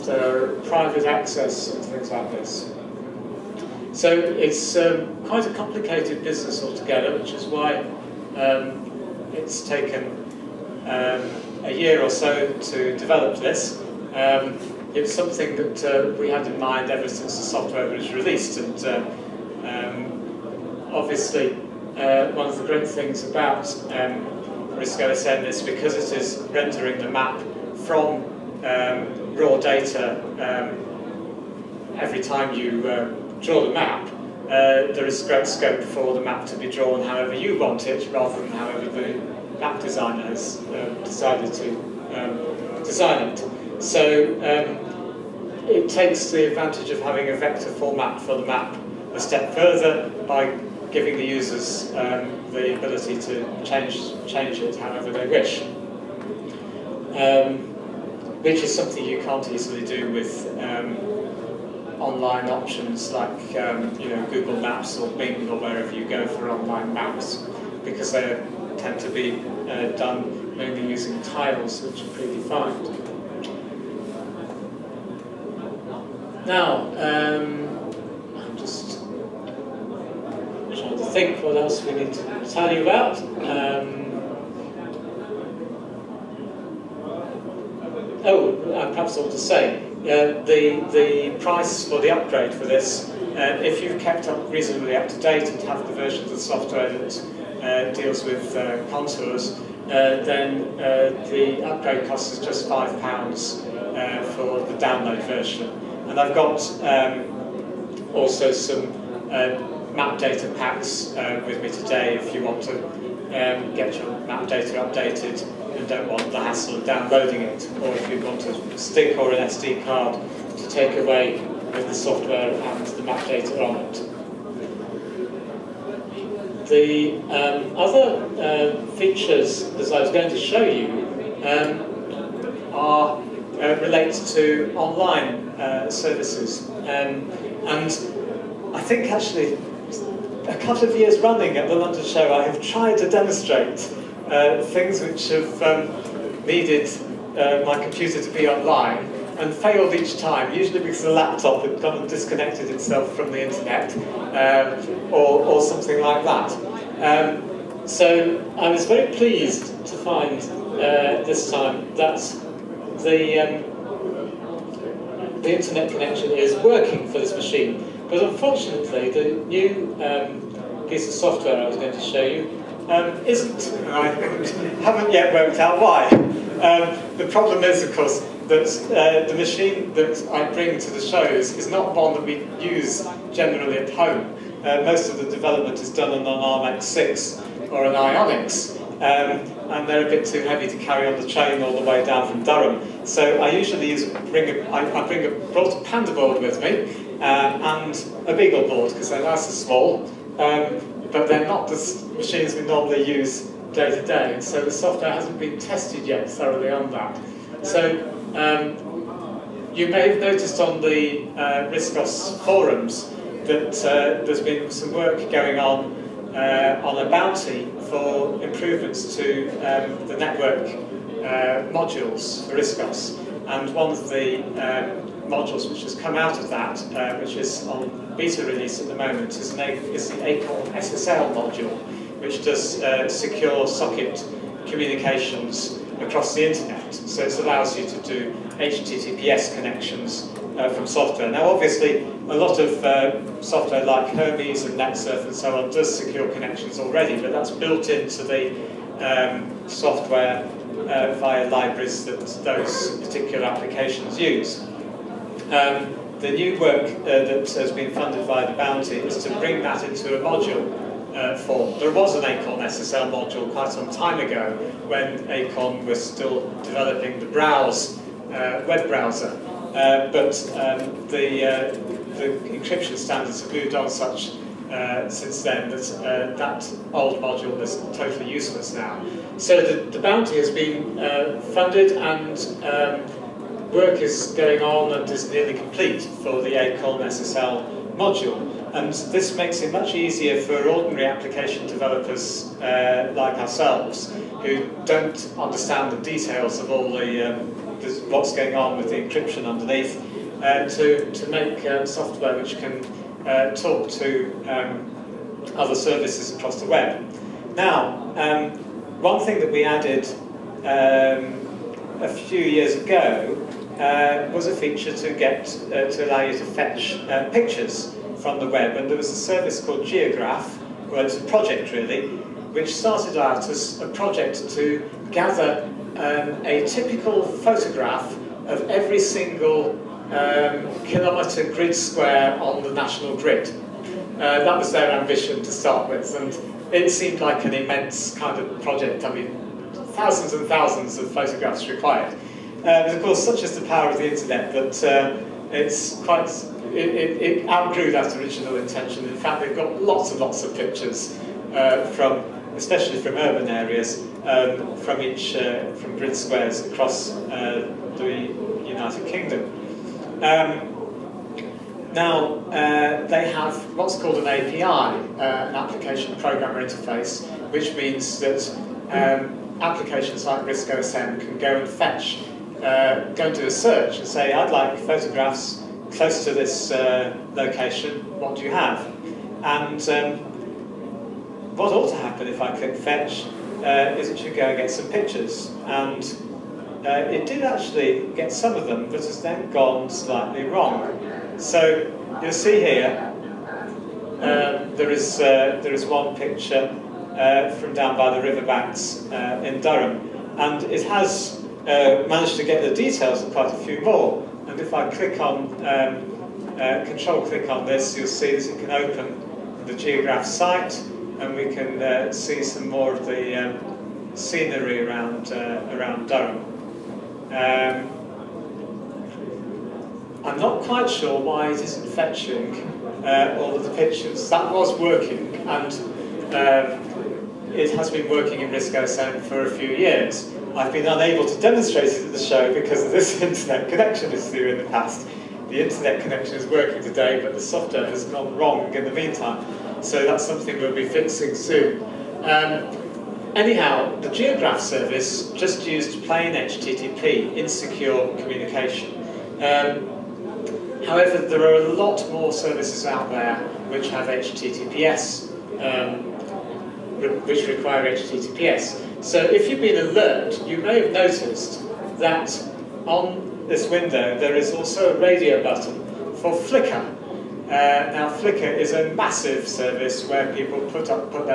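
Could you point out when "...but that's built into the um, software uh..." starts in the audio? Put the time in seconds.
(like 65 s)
247 s.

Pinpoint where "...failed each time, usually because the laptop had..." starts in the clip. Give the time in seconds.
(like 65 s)
149 s.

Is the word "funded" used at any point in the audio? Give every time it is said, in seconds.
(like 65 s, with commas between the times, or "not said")
257 s, 281 s.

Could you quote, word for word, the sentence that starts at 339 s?
I mean, thousands and thousands of photographs required.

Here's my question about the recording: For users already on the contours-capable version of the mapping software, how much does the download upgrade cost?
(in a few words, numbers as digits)
£5.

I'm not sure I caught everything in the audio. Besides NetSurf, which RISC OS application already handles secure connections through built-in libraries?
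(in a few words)
Hermes.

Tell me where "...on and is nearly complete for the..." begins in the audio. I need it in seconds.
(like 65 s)
284 s.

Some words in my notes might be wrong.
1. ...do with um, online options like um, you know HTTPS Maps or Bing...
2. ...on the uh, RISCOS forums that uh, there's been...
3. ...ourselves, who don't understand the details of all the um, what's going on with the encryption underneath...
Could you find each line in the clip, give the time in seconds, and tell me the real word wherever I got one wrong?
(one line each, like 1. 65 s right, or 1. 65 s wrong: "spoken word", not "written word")
1. 59 s wrong: "Google", not "HTTPS"
2. 210 s right
3. 293 s right.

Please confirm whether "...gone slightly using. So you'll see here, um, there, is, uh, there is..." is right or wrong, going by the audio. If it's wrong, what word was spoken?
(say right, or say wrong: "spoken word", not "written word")
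wrong: "wrong", not "using".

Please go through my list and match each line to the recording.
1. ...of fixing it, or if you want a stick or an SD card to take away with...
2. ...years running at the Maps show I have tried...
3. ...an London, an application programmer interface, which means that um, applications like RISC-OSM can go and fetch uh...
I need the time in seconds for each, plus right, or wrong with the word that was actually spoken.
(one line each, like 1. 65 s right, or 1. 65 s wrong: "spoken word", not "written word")
1. 116 s wrong: "downloading", not "fixing"
2. 140 s wrong: "London", not "Maps"
3. 364 s wrong: "API", not "London".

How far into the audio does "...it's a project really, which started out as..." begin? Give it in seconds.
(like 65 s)
321 s.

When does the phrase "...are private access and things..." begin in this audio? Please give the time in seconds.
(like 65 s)
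0 s.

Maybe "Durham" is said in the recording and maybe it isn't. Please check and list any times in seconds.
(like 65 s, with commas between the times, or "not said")
192 s, 399 s, 416 s.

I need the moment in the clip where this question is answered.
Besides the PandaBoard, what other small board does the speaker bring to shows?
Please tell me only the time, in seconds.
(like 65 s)
198 s.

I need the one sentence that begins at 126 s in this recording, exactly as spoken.
The um, other uh, features that I was going to show you um, are uh, relate to online uh, services.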